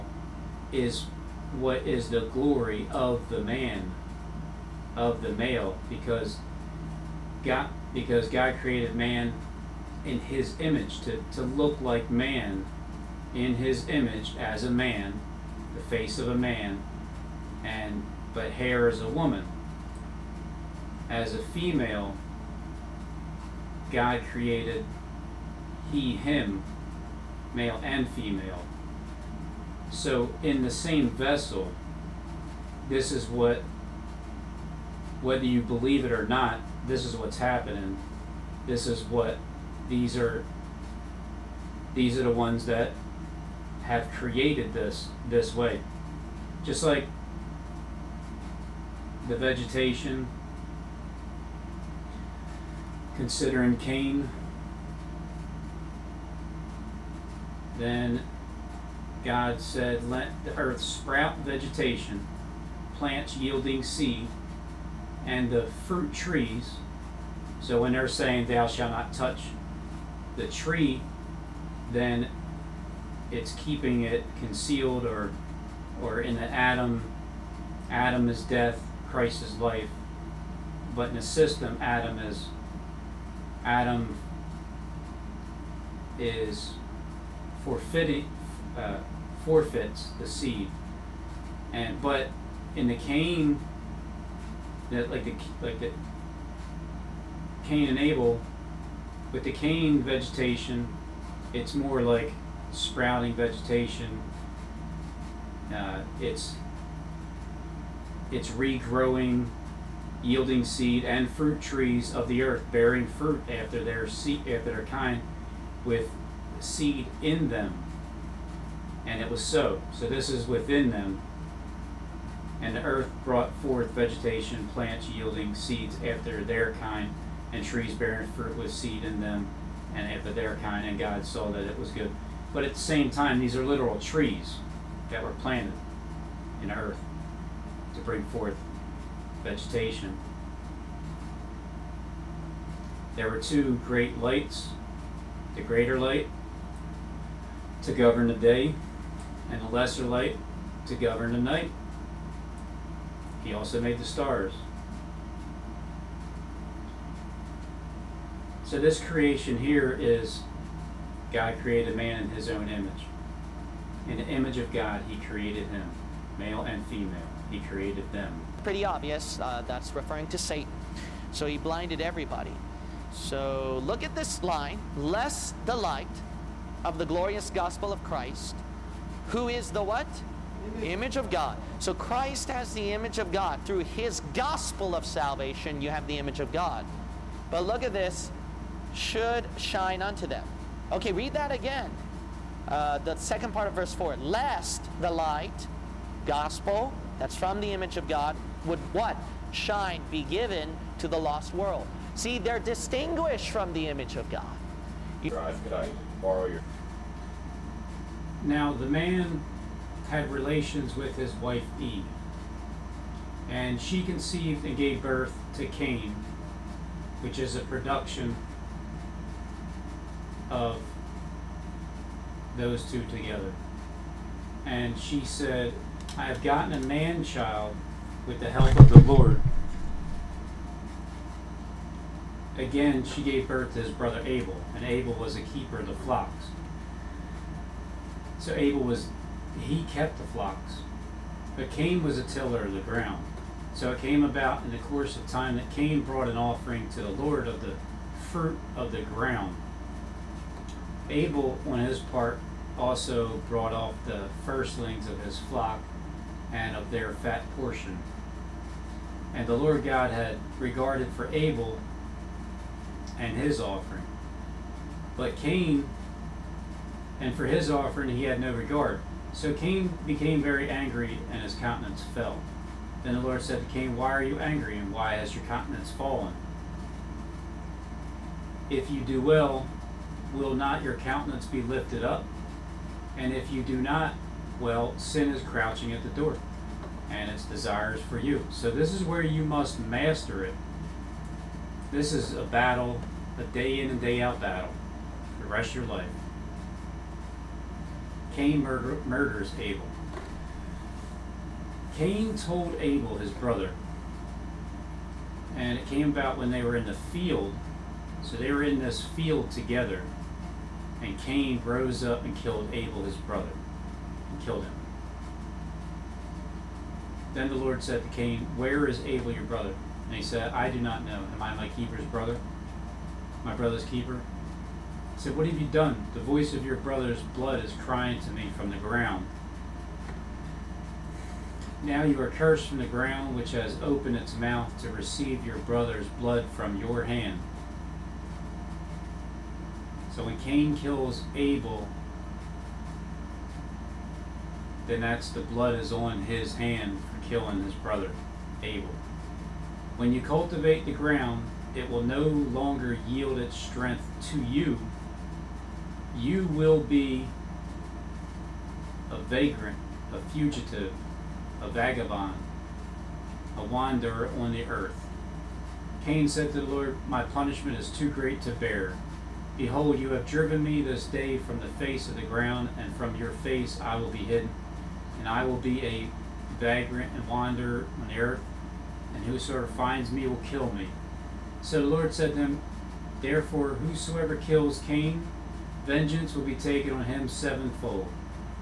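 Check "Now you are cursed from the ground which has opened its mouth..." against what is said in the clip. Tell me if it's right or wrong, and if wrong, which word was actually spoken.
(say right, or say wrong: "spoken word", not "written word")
right.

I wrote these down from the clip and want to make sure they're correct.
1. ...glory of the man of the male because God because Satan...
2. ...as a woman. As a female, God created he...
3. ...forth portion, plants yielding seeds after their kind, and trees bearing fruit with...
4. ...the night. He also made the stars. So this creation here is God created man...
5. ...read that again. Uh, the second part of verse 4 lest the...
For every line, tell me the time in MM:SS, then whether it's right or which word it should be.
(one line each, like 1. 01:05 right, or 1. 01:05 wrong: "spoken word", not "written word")
1. 00:02 wrong: "God", not "Satan"
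2. 00:18 right
3. 02:03 wrong: "vegetation", not "portion"
4. 02:31 right
5. 03:11 right.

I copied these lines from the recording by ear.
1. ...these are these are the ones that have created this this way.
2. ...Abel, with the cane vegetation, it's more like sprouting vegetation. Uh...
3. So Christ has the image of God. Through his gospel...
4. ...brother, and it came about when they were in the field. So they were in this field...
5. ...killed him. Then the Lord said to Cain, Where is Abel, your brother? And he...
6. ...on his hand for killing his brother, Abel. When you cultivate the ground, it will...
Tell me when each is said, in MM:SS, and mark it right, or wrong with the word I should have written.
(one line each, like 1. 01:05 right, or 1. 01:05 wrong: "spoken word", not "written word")
1. 00:39 right
2. 01:37 right
3. 03:01 right
4. 05:03 right
5. 05:14 right
6. 05:45 right.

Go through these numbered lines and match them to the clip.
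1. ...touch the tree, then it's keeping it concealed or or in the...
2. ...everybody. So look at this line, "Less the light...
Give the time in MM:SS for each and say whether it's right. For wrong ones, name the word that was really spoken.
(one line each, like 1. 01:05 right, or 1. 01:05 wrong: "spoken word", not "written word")
1. 01:09 right
2. 02:51 right.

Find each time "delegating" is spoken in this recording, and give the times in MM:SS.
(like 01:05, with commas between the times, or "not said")
not said.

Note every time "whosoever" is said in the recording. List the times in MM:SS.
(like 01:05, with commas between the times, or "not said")
06:19, 06:23.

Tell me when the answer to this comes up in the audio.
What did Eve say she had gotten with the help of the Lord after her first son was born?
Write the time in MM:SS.
03:46.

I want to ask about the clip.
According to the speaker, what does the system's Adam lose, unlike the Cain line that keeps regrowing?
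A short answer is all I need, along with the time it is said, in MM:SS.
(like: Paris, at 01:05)
The seed, at 01:29.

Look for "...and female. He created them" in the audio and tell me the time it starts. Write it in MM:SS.
02:46.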